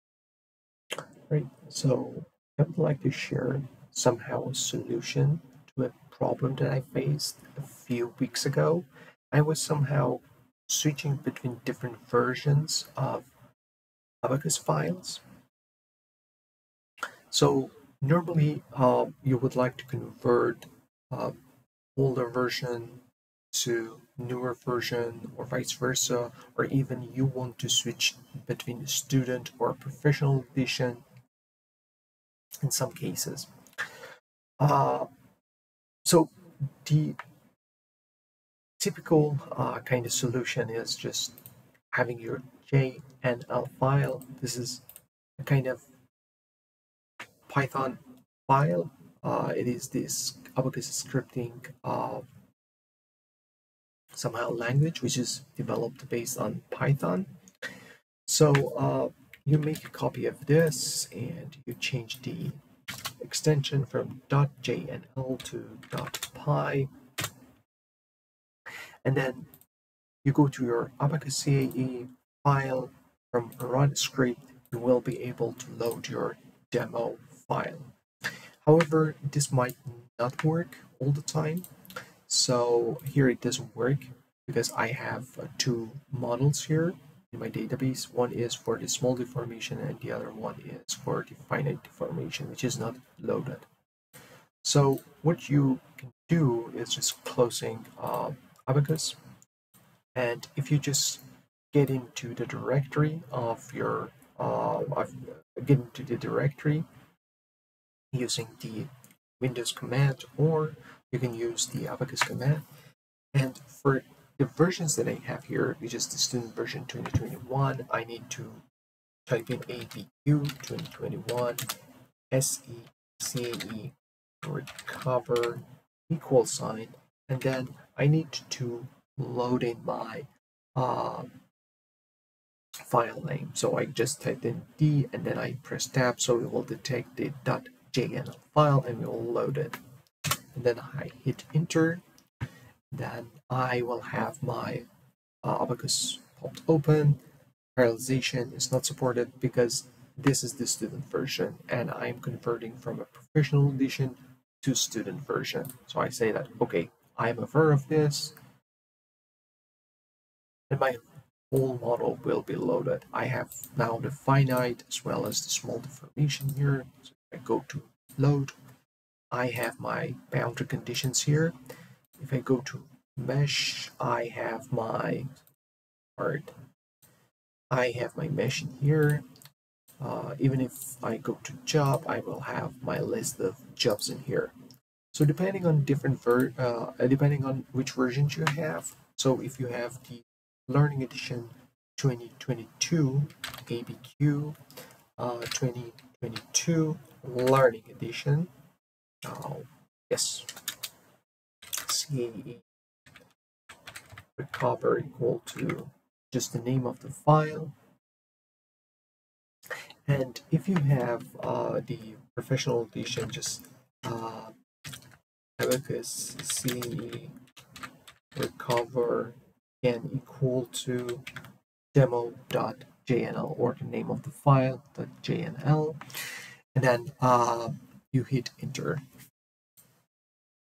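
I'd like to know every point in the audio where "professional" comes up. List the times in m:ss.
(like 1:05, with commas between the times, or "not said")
0:29, 2:33, 3:32.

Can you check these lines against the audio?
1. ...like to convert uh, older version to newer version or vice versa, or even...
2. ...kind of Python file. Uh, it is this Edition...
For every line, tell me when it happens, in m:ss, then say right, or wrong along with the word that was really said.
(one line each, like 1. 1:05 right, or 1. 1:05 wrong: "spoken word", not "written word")
1. 0:19 right
2. 0:45 wrong: "Abaqus", not "Edition".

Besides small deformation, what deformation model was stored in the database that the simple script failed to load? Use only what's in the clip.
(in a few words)
finite deformation.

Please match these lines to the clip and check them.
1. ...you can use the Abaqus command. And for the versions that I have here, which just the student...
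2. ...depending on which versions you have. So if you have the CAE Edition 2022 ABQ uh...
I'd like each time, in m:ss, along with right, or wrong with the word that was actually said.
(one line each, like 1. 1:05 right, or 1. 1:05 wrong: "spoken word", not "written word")
1. 1:51 right
2. 3:07 wrong: "Learning", not "CAE".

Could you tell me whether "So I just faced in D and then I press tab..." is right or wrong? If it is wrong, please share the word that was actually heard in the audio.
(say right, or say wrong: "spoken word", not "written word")
wrong: "typed", not "faced".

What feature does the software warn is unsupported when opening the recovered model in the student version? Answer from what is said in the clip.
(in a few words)
Parallelization.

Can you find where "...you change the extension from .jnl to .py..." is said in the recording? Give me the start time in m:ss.
1:01.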